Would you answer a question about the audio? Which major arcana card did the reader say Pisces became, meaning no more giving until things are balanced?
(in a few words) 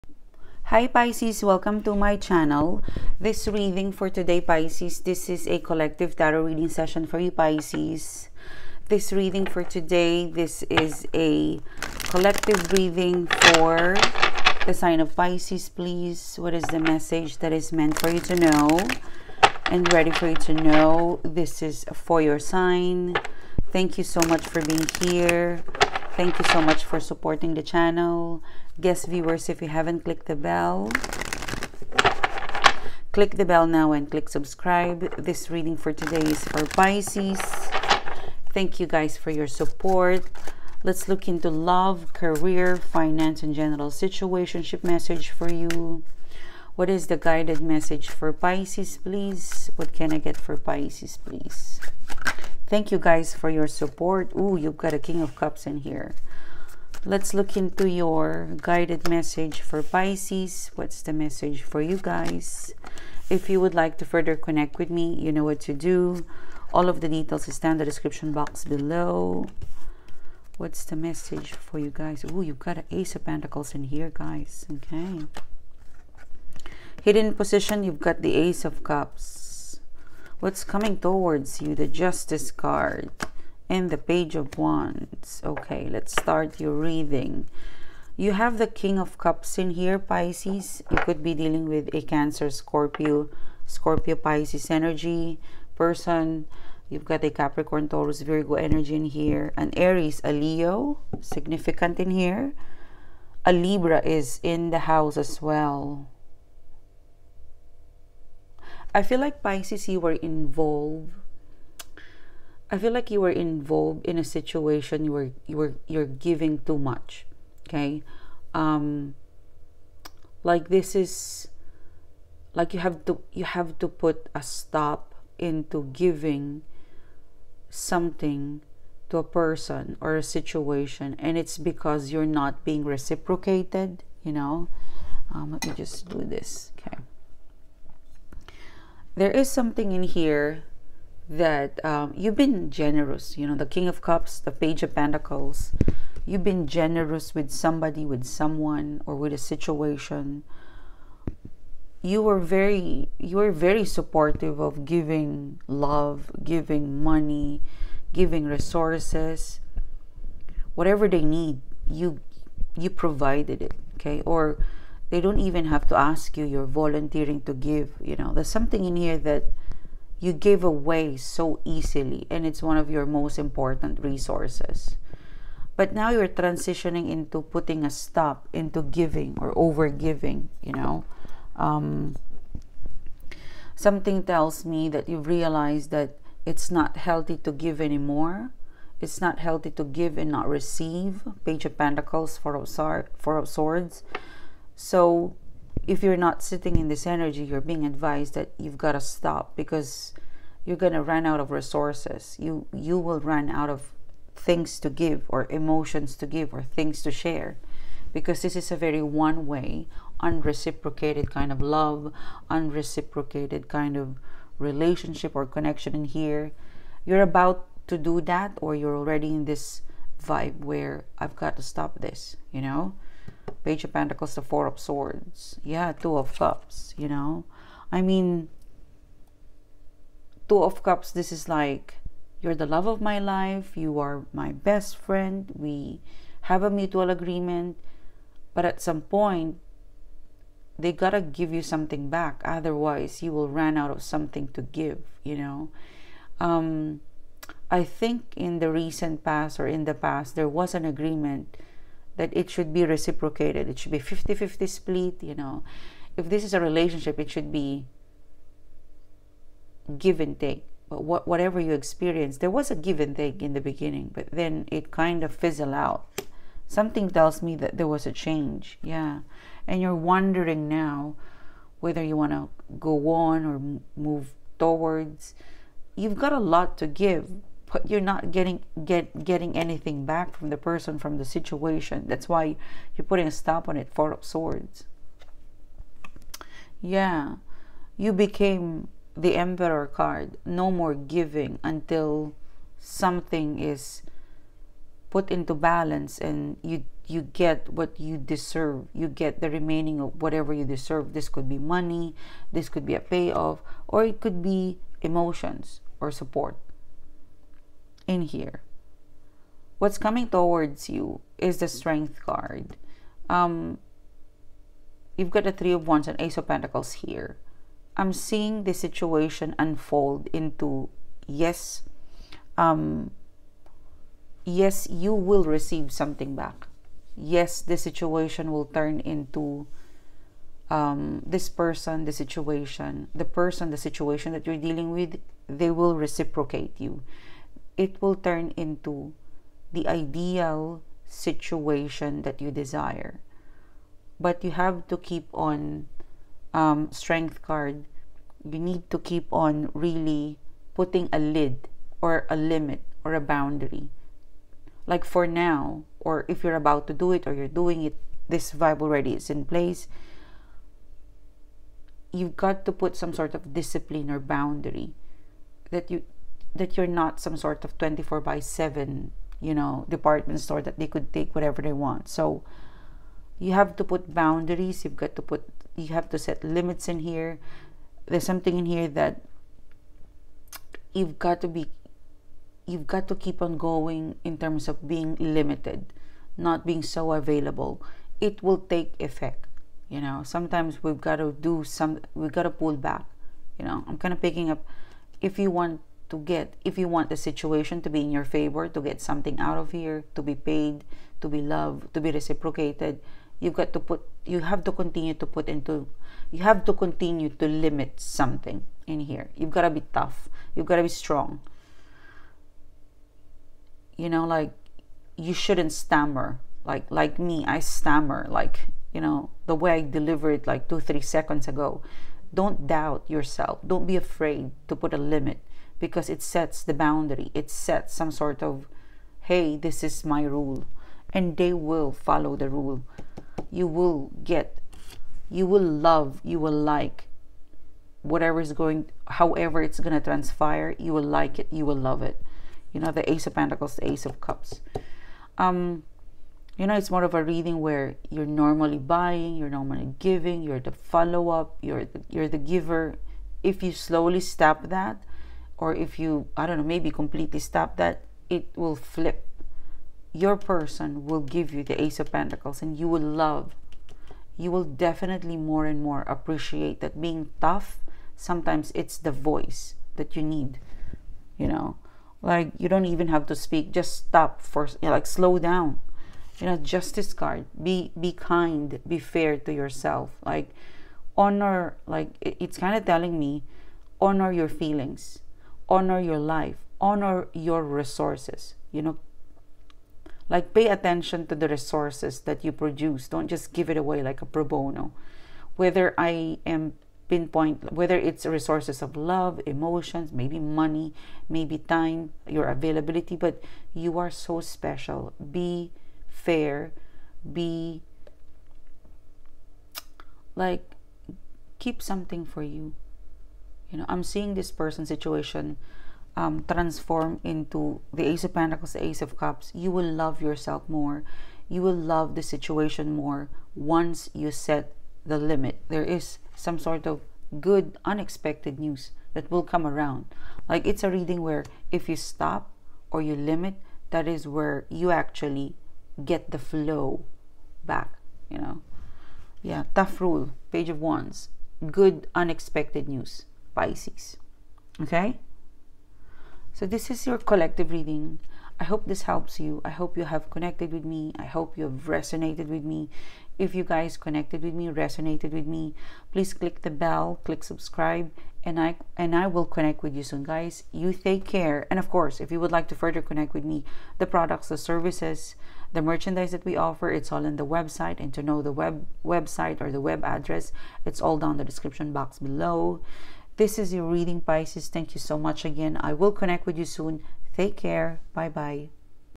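The Emperor.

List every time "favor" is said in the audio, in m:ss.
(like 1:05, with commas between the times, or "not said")
6:38.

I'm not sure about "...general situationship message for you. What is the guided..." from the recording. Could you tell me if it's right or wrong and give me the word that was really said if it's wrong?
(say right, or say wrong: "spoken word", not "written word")
right.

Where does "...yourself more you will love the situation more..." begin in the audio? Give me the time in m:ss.
8:40.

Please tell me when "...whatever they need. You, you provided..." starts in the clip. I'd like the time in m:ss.
2:40.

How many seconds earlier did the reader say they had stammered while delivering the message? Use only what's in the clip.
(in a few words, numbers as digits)
2 or 3 seconds.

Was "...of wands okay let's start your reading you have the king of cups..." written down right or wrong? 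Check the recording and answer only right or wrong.
right.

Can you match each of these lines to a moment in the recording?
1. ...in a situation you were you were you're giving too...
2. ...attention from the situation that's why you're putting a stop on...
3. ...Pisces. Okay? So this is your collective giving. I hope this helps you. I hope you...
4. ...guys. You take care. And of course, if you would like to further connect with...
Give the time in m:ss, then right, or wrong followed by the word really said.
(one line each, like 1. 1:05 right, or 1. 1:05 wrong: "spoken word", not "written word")
1. 1:54 right
2. 4:40 wrong: "person", not "attention"
3. 9:03 wrong: "reading", not "giving"
4. 9:20 right.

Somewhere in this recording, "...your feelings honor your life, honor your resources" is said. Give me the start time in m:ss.
8:04.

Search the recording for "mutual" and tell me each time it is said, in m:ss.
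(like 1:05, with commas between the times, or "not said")
3:56.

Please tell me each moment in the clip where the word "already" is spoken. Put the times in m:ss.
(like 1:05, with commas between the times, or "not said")
3:38, 5:58.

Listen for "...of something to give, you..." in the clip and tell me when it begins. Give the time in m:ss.
4:03.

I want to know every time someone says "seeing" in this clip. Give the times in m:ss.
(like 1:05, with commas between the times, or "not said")
5:18, 8:34.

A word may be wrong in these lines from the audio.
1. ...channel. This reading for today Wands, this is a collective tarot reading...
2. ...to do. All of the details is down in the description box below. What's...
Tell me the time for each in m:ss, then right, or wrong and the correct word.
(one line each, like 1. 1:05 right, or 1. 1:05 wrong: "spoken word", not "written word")
1. 0:02 wrong: "Pisces", not "Wands"
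2. 1:05 right.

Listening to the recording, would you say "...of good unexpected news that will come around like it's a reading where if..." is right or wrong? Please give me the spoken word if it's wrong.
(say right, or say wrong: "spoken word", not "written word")
right.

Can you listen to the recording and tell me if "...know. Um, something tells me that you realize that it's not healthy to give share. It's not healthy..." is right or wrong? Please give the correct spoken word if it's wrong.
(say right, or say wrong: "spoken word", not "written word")
wrong: "anymore", not "share".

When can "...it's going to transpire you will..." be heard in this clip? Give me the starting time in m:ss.
7:19.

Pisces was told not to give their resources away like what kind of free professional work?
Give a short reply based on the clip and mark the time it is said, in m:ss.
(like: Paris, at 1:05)
Pro bono, at 8:14.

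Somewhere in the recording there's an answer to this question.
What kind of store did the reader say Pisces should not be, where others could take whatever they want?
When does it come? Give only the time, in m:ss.
6:09.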